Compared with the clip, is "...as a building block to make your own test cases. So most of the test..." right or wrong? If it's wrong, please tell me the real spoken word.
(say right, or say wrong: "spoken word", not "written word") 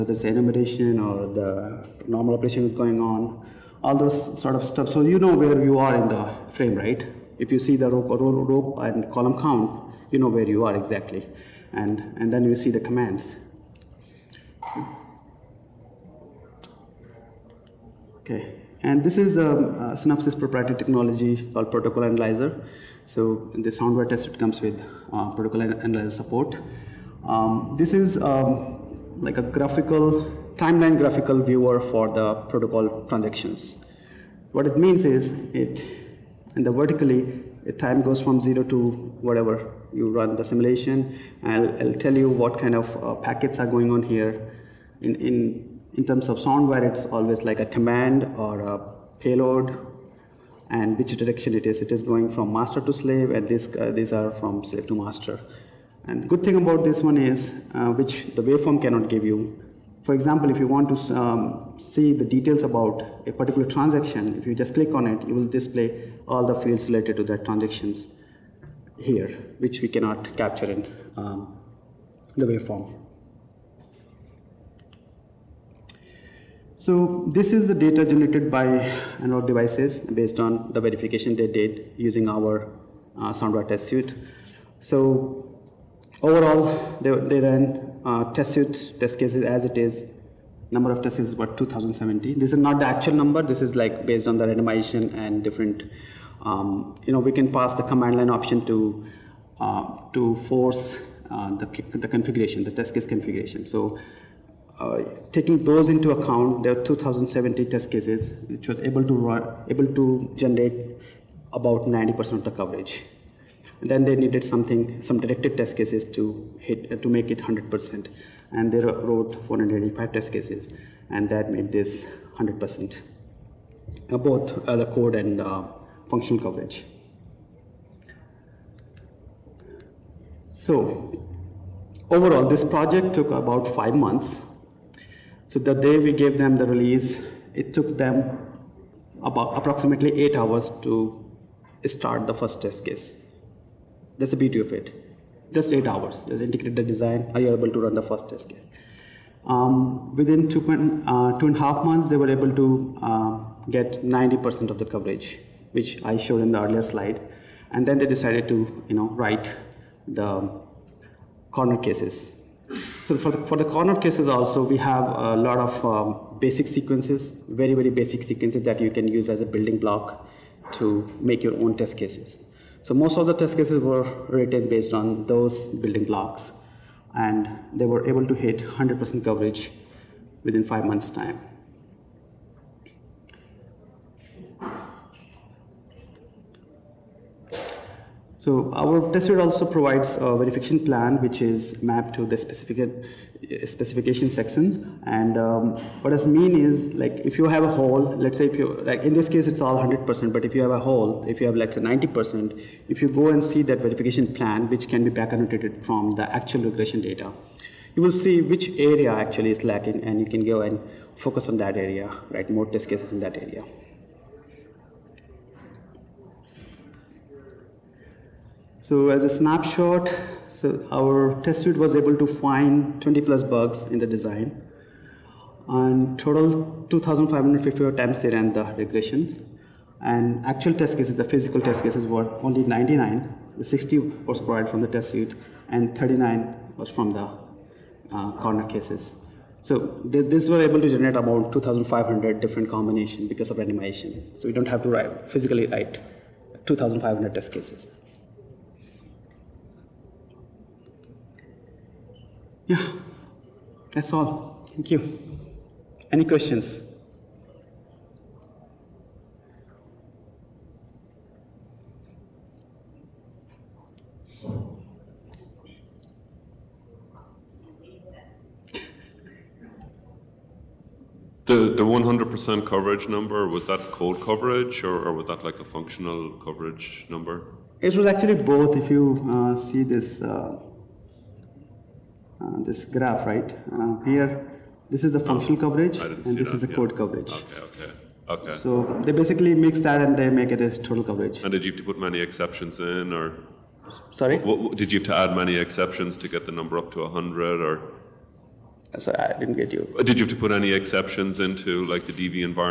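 right.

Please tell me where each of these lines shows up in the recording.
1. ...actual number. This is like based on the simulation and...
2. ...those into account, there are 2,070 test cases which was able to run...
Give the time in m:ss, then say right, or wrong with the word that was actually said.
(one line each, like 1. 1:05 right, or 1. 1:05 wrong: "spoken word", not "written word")
1. 1:32 wrong: "randomization", not "simulation"
2. 1:45 right.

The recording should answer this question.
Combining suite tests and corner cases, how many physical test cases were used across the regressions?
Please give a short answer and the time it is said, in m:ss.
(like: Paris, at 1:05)
99, at 3:52.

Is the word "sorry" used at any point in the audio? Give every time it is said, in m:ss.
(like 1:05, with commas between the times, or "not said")
4:54, 4:58.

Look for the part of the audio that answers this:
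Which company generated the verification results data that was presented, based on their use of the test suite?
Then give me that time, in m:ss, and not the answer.
1:19.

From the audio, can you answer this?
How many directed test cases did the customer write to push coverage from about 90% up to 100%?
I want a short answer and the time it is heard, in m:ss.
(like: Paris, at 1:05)
485, at 1:59.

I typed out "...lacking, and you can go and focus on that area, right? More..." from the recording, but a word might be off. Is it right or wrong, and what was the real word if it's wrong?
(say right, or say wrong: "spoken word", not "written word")
right.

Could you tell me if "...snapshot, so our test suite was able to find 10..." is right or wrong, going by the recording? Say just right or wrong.
wrong.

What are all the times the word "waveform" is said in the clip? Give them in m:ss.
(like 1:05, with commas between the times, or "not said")
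0:58, 1:12.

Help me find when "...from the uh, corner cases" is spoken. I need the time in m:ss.
3:56.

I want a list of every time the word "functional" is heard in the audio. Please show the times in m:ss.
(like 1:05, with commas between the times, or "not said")
2:06, 4:35, 4:45.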